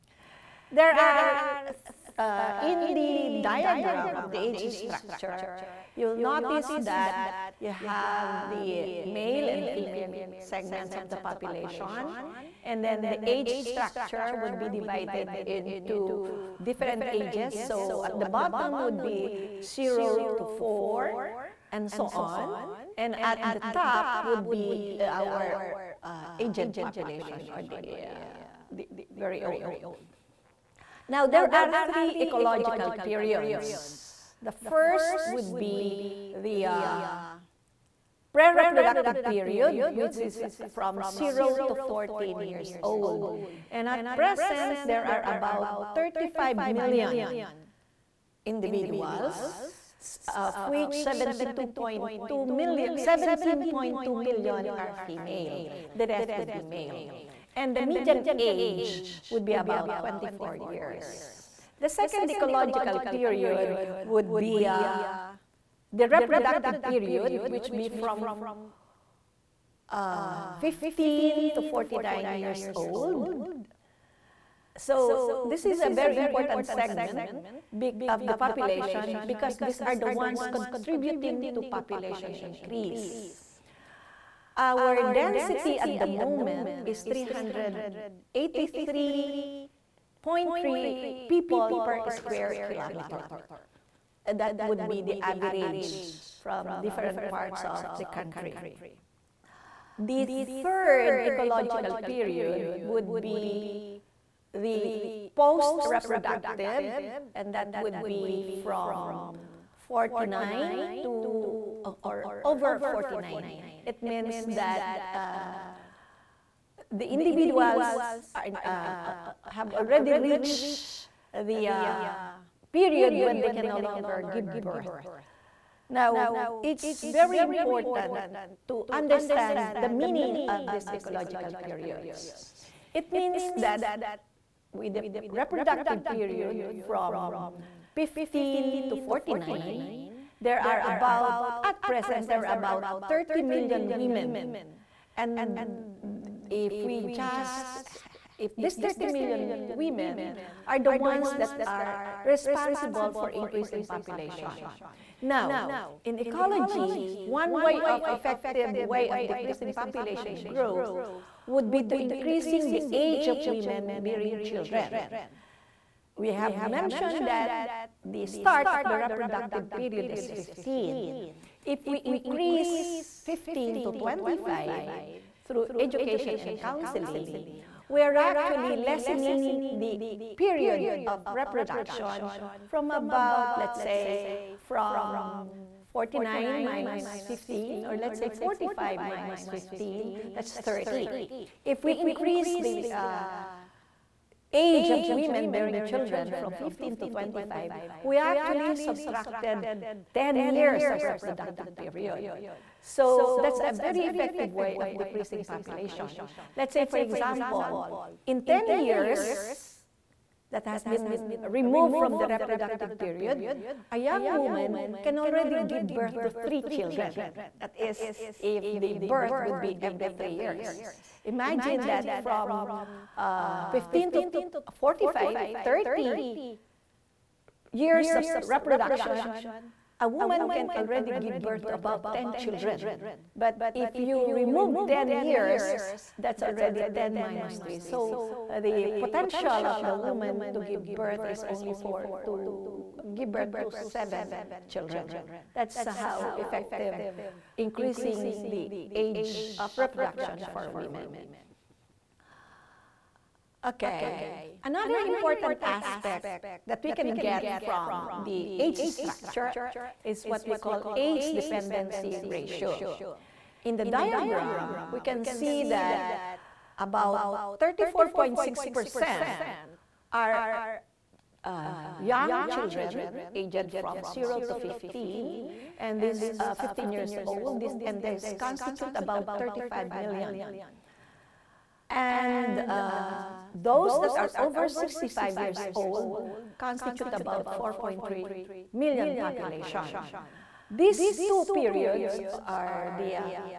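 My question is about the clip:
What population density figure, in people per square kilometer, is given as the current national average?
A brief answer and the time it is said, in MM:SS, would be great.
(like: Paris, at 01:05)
383.3, at 01:27.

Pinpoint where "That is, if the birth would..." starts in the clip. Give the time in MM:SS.
03:37.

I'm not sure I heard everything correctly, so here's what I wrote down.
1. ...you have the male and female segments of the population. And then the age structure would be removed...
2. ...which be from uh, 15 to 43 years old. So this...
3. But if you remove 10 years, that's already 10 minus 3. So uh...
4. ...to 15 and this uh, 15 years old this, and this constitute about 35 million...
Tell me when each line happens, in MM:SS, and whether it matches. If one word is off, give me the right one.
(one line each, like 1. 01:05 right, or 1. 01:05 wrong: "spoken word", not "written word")
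1. 00:07 wrong: "divided", not "removed"
2. 01:07 wrong: "49", not "43"
3. 03:53 right
4. 04:34 right.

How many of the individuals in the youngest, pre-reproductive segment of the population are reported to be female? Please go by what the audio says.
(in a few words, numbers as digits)
17.2 million.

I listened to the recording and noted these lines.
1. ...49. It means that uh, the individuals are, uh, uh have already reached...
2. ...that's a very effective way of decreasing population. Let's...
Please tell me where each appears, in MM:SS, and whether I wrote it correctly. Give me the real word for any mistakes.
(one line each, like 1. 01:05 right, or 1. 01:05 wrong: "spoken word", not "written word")
1. 01:52 right
2. 03:23 right.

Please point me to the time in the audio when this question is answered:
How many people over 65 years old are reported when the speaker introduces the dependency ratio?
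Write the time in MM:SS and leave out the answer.
04:47.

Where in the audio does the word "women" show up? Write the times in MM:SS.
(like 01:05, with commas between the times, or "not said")
02:23, 02:29, 02:43, 03:15, 04:10.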